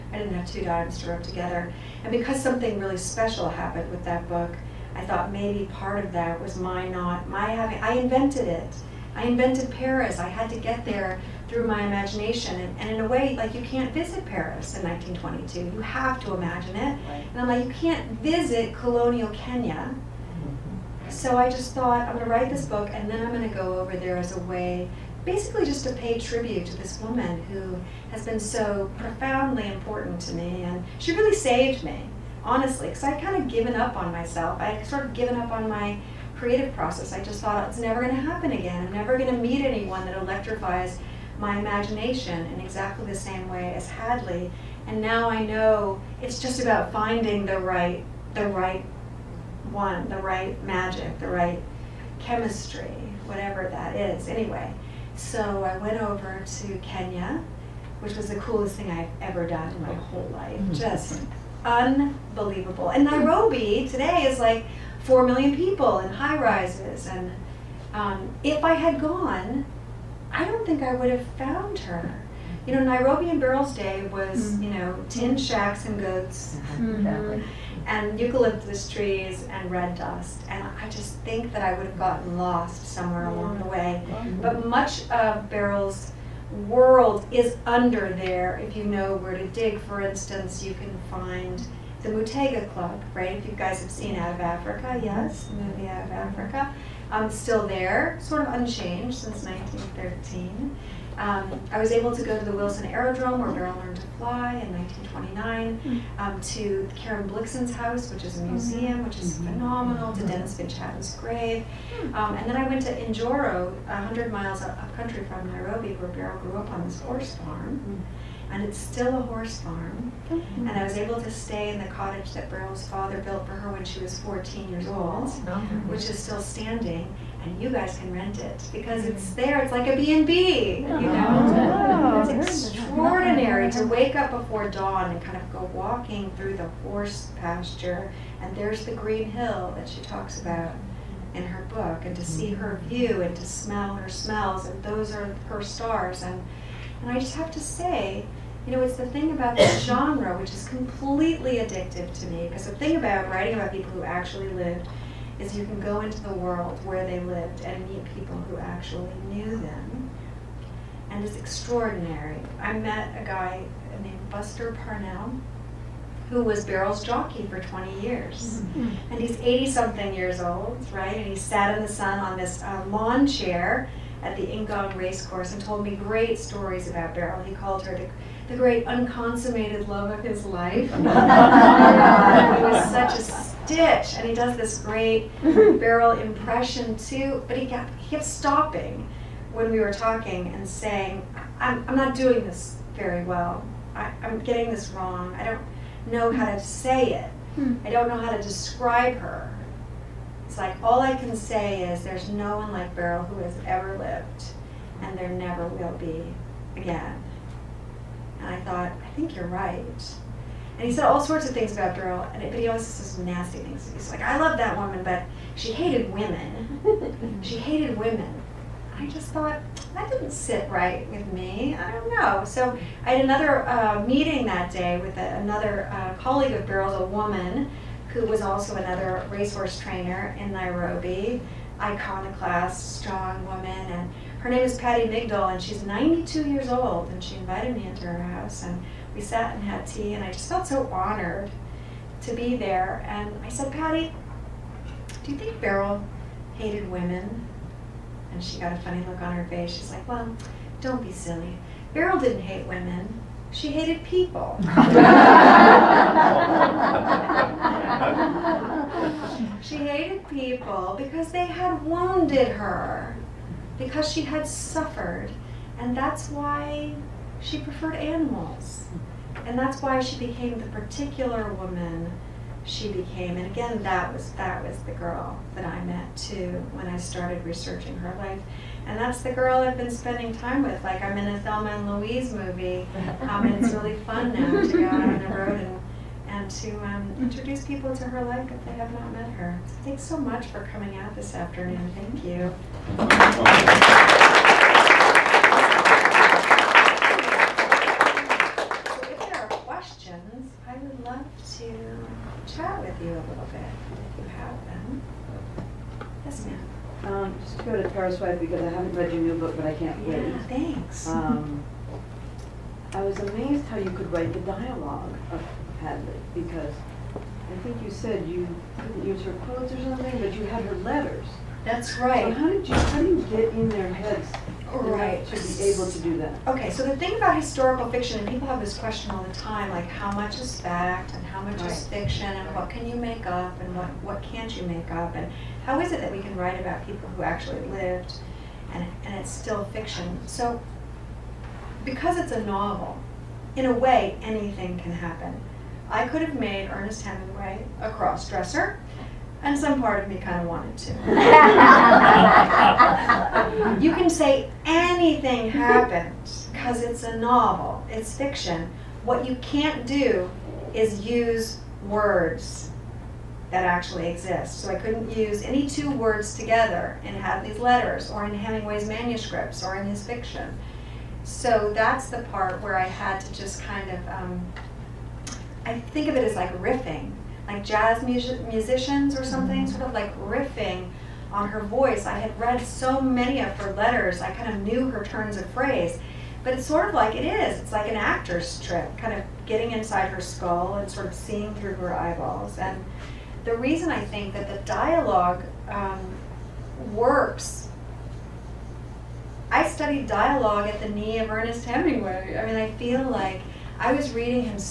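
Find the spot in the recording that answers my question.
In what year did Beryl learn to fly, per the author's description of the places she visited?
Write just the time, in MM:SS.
01:44.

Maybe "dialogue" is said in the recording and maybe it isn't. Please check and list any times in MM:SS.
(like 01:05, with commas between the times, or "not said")
05:14, 06:34, 06:40.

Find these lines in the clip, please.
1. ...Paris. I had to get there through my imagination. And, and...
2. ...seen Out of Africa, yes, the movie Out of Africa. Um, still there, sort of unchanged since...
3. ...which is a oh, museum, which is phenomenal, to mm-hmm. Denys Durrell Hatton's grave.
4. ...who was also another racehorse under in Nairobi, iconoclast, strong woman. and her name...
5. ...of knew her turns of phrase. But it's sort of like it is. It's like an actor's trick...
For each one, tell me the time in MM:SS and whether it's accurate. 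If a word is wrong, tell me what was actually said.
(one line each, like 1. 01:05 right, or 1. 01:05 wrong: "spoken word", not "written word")
1. 00:09 right
2. 01:33 right
3. 01:48 wrong: "Finch", not "Durrell"
4. 03:48 wrong: "trainer", not "under"
5. 06:24 right.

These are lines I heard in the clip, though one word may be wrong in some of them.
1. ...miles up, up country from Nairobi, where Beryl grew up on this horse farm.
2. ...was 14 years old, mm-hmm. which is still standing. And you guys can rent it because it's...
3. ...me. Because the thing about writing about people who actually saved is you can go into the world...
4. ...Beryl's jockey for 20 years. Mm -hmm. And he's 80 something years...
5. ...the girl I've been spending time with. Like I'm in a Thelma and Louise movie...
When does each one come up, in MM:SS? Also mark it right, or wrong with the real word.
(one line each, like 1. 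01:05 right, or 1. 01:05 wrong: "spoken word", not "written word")
1. 01:54 right
2. 02:04 right
3. 02:32 wrong: "lived", not "saved"
4. 02:46 right
5. 04:39 right.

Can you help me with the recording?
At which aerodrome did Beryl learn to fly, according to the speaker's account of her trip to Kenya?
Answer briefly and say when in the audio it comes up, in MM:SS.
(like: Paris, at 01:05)
Wilson Aerodrome, at 01:42.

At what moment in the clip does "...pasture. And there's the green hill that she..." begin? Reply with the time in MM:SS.
02:17.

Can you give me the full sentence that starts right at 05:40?
So because it's a novel, in a way anything can happen.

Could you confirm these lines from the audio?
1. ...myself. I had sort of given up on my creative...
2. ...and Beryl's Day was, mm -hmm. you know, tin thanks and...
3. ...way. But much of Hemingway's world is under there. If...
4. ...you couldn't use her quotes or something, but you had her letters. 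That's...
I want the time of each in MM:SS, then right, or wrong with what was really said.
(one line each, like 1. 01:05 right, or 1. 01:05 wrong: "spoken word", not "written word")
1. 00:34 right
2. 01:13 wrong: "shacks", not "thanks"
3. 01:23 wrong: "Beryl", not "Hemingway"
4. 05:18 right.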